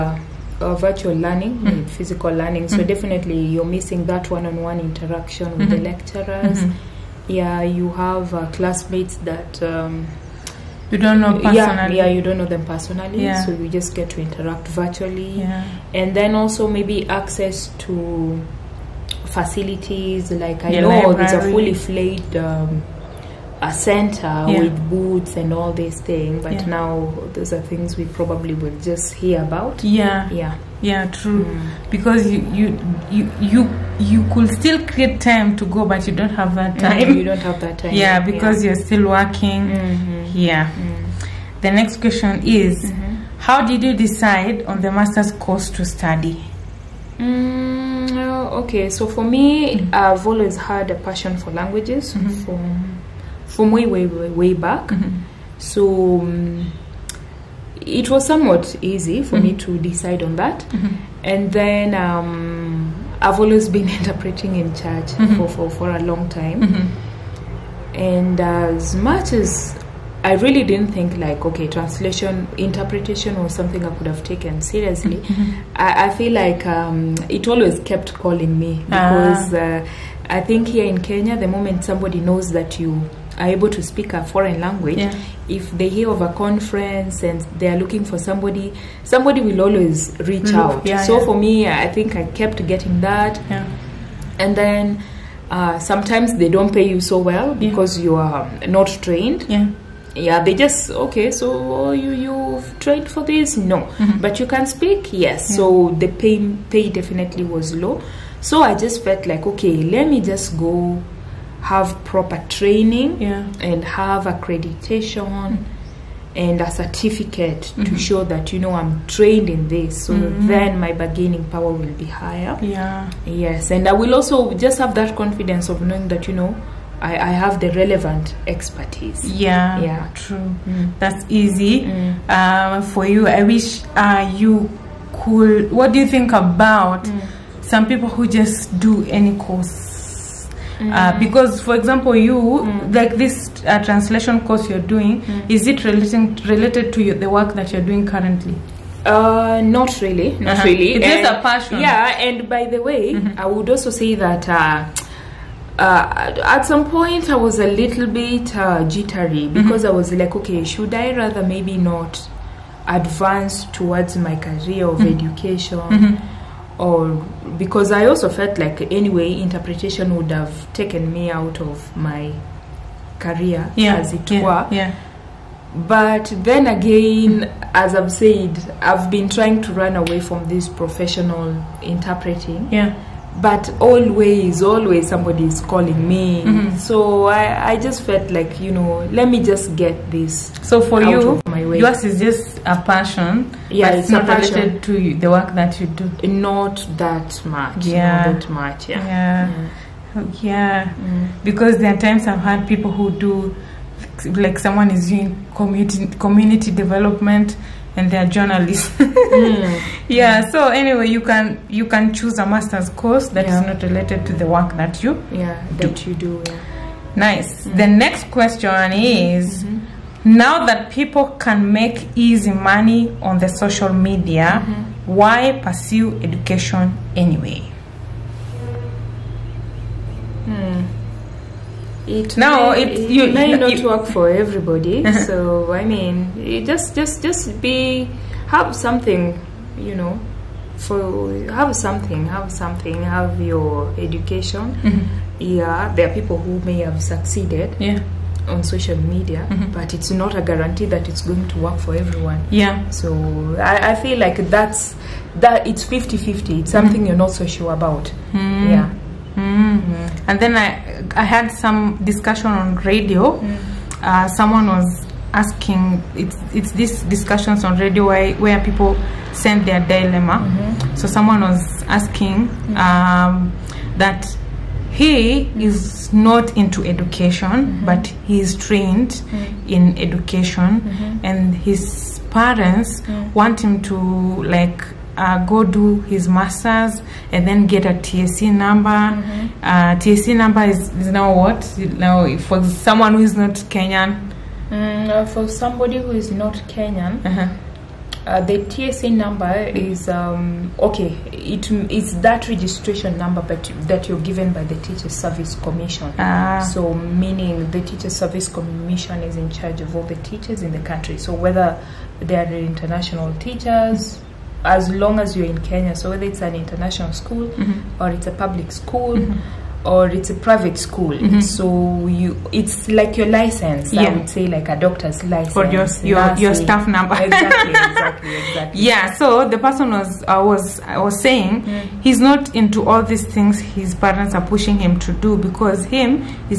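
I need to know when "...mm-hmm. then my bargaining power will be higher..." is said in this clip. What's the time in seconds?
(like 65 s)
120 s.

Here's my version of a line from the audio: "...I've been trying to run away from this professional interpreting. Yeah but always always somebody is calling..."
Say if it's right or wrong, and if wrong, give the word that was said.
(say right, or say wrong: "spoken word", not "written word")
right.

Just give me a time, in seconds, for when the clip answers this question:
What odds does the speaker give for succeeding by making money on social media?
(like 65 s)
255 s.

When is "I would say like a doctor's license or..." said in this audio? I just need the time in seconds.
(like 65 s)
324 s.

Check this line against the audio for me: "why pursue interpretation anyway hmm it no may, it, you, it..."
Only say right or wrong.
wrong.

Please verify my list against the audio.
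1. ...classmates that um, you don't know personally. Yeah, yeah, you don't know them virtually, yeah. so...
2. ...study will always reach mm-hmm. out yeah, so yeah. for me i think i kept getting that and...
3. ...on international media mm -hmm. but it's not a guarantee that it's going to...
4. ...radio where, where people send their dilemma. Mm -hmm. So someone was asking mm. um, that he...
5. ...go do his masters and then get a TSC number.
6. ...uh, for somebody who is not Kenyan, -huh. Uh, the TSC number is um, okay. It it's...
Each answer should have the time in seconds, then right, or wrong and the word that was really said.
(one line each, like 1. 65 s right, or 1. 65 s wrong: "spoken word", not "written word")
1. 8 s wrong: "personally", not "virtually"
2. 89 s wrong: "somebody", not "study"
3. 248 s wrong: "social", not "international"
4. 267 s right
5. 285 s right
6. 295 s right.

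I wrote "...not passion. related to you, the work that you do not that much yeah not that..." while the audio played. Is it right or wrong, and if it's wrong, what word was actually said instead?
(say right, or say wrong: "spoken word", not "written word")
right.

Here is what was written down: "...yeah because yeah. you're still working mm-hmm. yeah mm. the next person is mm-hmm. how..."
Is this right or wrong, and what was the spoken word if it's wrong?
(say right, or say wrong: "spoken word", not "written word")
wrong: "question", not "person".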